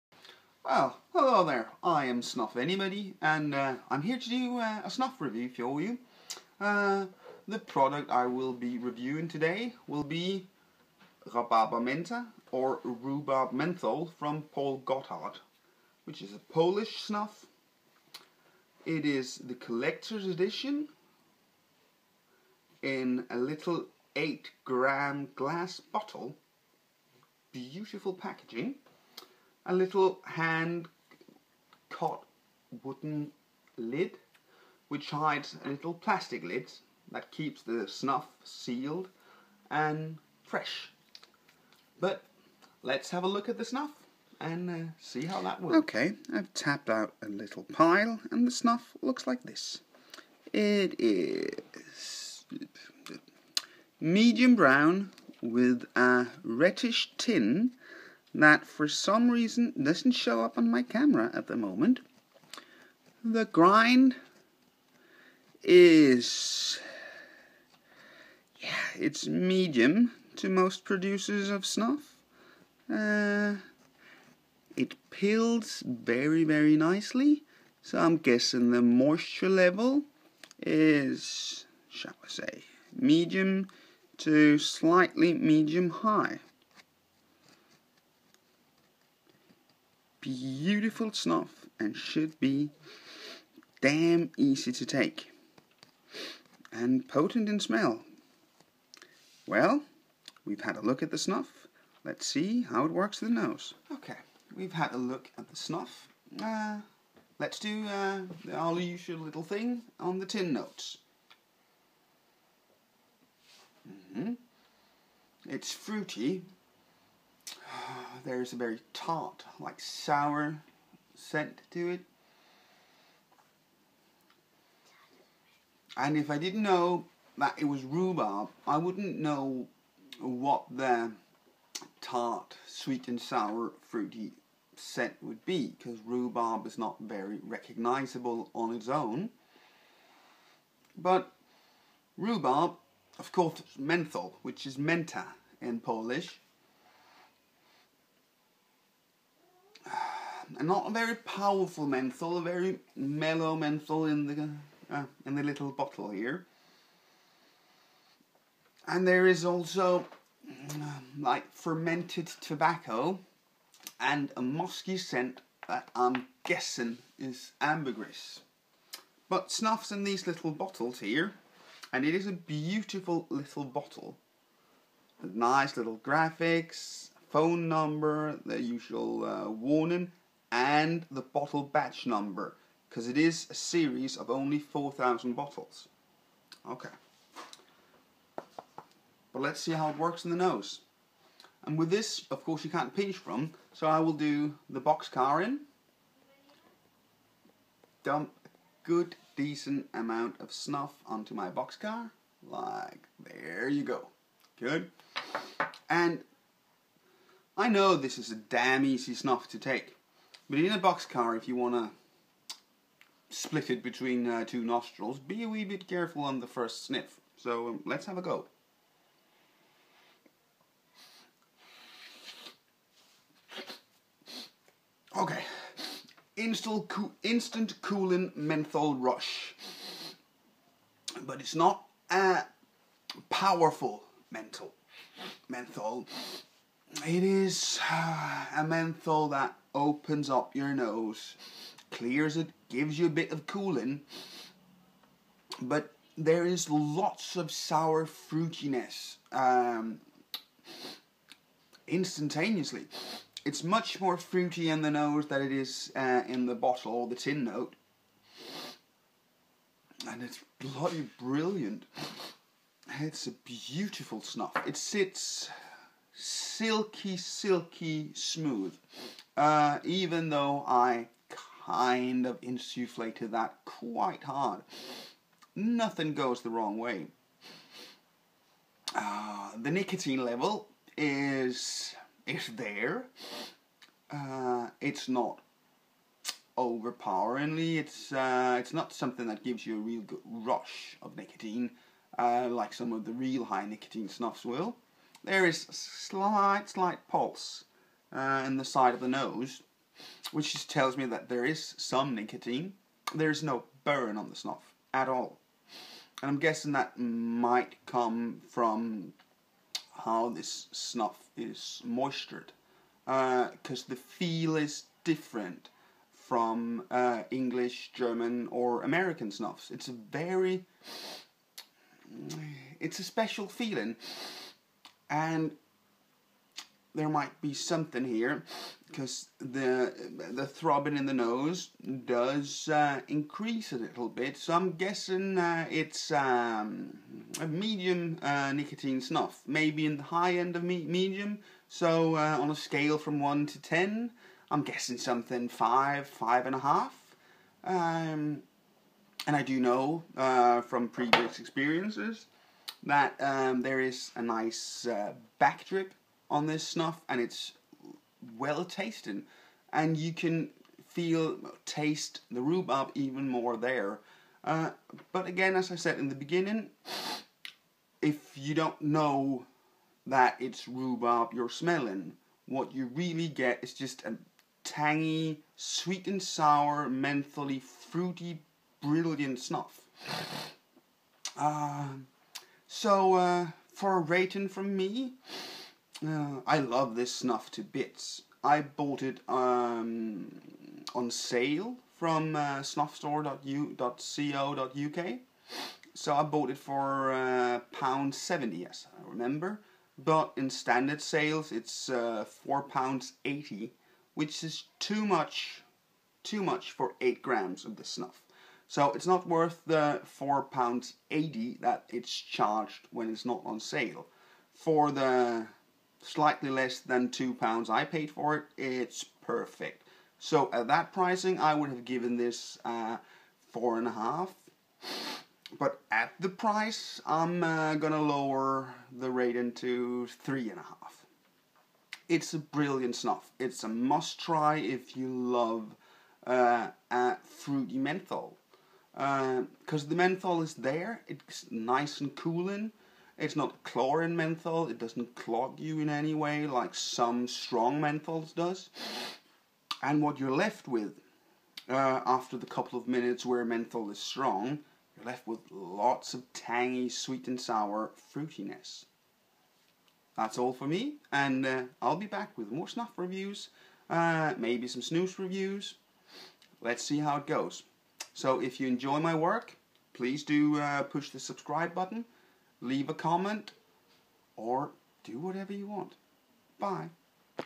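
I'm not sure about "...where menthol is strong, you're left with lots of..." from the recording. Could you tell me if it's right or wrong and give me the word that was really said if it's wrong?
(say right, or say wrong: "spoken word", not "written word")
right.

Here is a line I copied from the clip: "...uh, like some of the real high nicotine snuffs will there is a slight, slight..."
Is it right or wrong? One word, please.
right.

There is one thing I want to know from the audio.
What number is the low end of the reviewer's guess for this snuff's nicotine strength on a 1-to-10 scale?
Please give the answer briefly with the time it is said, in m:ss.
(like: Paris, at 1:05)
5, at 5:45.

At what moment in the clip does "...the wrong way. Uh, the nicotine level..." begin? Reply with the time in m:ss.
4:36.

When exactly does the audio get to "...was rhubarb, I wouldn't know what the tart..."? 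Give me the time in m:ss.
2:07.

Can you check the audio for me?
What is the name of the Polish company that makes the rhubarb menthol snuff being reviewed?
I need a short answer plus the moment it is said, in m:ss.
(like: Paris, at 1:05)
Paul Gotard, at 0:14.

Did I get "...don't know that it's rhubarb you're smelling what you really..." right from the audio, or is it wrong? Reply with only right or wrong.
right.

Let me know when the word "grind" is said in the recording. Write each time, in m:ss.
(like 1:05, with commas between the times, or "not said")
1:03.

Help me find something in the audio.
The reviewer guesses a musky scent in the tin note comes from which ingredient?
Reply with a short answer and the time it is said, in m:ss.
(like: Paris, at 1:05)
Ambergris, at 2:47.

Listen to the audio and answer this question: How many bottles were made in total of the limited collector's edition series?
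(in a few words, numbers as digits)
4,000.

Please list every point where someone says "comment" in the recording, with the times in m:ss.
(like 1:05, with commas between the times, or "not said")
7:52.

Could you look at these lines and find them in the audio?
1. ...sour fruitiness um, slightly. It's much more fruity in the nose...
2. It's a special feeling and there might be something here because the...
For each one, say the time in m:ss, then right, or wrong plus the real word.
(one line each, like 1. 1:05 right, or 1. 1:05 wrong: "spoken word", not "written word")
1. 4:07 wrong: "instantaneously", not "slightly"
2. 5:22 right.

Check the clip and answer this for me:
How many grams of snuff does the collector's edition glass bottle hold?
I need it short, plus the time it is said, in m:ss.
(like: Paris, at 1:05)
8 grams, at 0:24.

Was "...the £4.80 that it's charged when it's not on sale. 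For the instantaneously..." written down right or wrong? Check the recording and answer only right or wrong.
wrong.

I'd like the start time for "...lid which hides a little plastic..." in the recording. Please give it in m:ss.
0:33.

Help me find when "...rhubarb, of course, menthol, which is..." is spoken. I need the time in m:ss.
2:22.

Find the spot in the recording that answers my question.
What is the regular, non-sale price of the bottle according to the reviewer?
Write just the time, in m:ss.
6:42.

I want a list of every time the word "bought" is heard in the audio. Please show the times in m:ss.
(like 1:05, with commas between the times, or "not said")
6:28, 6:36.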